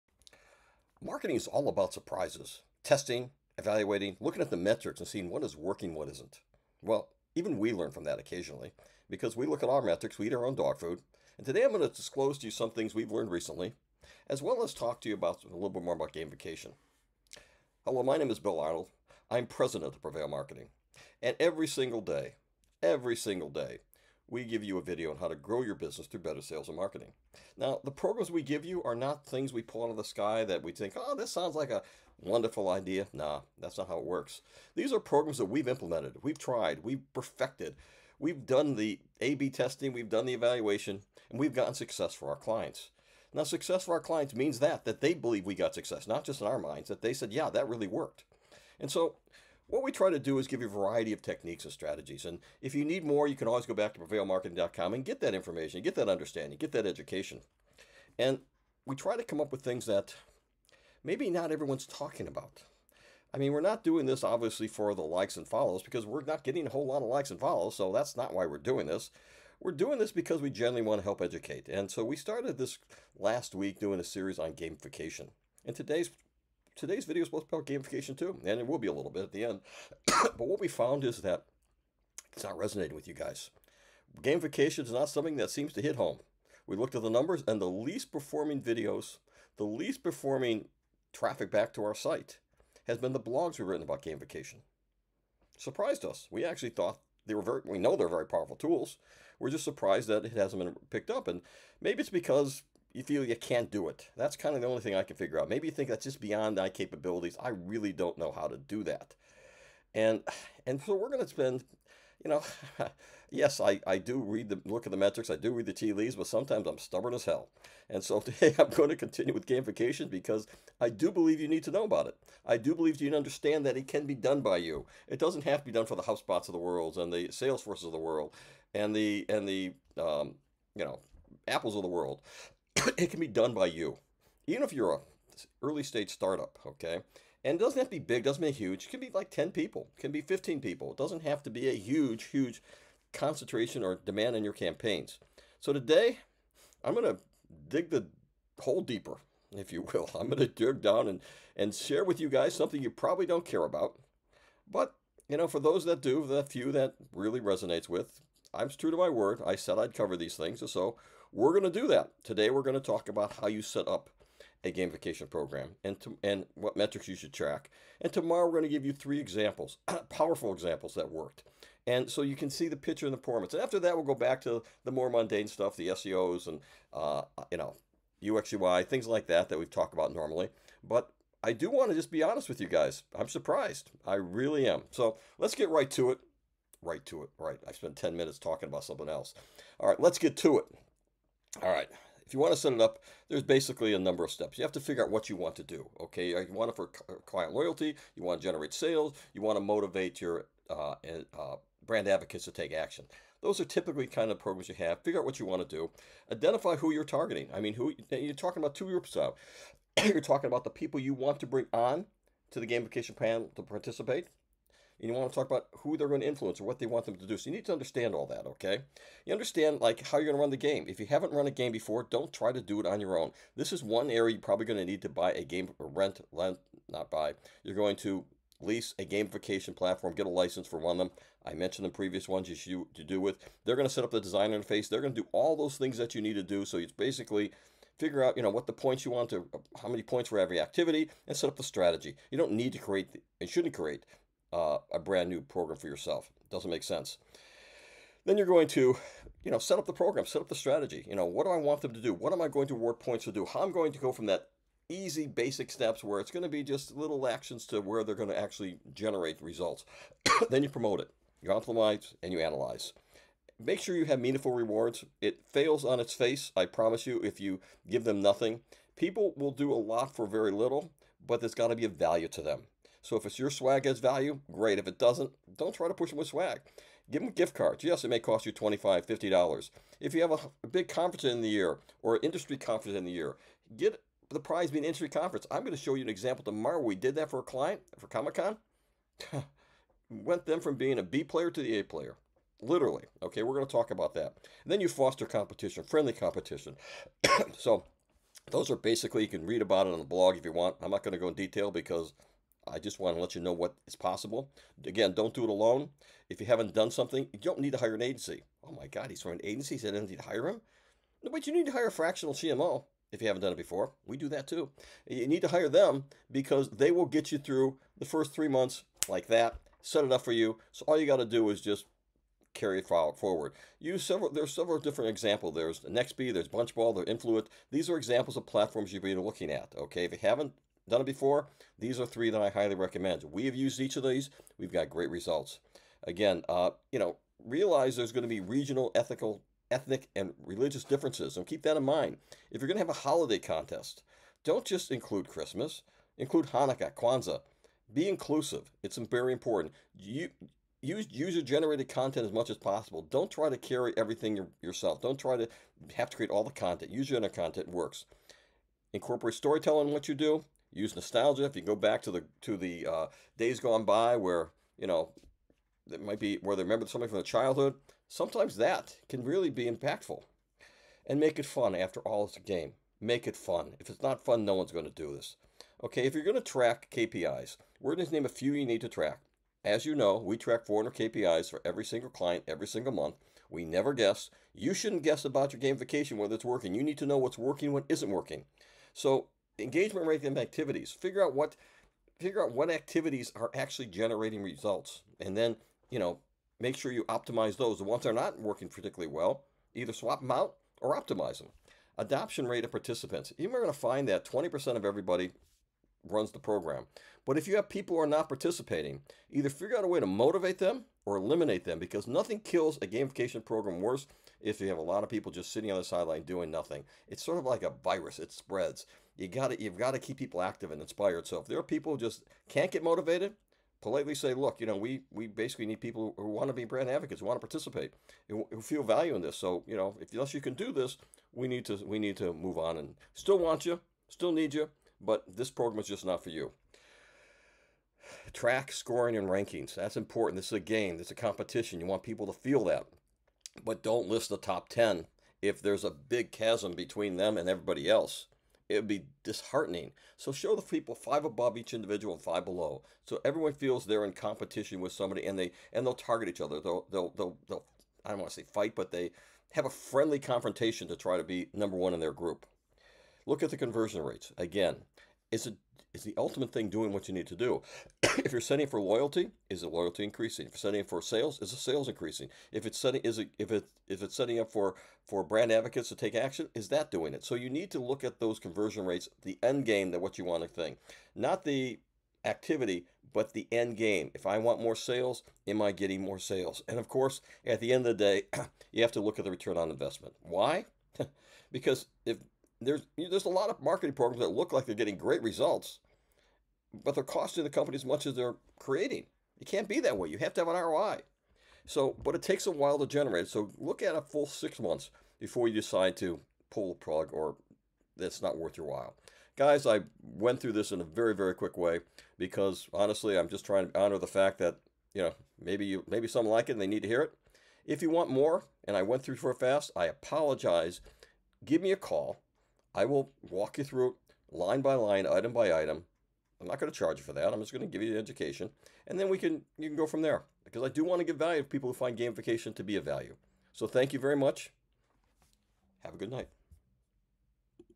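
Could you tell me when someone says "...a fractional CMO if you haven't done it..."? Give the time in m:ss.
5:11.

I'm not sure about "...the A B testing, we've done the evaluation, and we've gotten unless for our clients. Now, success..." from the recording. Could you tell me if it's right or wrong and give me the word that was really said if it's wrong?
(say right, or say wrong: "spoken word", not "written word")
wrong: "success", not "unless".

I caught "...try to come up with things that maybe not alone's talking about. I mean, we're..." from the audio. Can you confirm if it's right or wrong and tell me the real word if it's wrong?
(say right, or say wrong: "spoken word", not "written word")
wrong: "everyone", not "alone".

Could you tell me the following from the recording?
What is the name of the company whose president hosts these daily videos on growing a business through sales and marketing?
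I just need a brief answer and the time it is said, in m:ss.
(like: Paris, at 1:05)
Prevail Marketing, at 0:20.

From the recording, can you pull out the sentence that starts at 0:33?
Nah, that's not how it works.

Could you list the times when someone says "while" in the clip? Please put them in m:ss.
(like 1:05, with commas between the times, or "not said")
8:22, 8:28.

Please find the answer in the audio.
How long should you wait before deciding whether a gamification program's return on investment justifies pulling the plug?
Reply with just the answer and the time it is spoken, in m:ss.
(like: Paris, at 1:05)
6 months, at 8:24.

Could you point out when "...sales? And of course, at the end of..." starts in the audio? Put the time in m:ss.
8:06.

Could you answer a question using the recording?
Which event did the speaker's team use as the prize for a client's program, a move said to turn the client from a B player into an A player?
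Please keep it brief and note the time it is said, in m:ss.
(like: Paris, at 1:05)
Comic Con, at 4:48.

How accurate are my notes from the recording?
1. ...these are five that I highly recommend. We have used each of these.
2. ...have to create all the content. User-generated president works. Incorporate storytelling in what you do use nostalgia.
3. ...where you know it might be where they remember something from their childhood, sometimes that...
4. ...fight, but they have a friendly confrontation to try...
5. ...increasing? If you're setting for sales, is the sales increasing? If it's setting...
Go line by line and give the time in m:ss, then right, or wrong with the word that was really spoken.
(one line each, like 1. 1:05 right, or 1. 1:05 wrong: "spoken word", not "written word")
1. 5:31 wrong: "three", not "five"
2. 5:55 wrong: "content", not "president"
3. 6:04 right
4. 7:38 right
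5. 7:50 right.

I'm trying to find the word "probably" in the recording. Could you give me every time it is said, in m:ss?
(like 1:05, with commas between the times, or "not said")
2:32, 3:44.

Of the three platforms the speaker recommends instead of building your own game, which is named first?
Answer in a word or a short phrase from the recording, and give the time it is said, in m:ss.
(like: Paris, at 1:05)
Nextbee, at 5:25.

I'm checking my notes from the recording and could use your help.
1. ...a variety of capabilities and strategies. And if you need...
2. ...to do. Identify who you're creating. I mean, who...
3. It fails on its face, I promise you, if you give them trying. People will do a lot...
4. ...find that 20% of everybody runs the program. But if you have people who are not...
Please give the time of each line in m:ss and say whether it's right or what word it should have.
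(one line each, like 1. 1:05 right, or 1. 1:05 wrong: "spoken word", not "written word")
1. 0:50 wrong: "techniques", not "capabilities"
2. 3:25 wrong: "targeting", not "creating"
3. 4:25 wrong: "nothing", not "trying"
4. 6:43 right.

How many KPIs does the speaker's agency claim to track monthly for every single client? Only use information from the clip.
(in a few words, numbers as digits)
400.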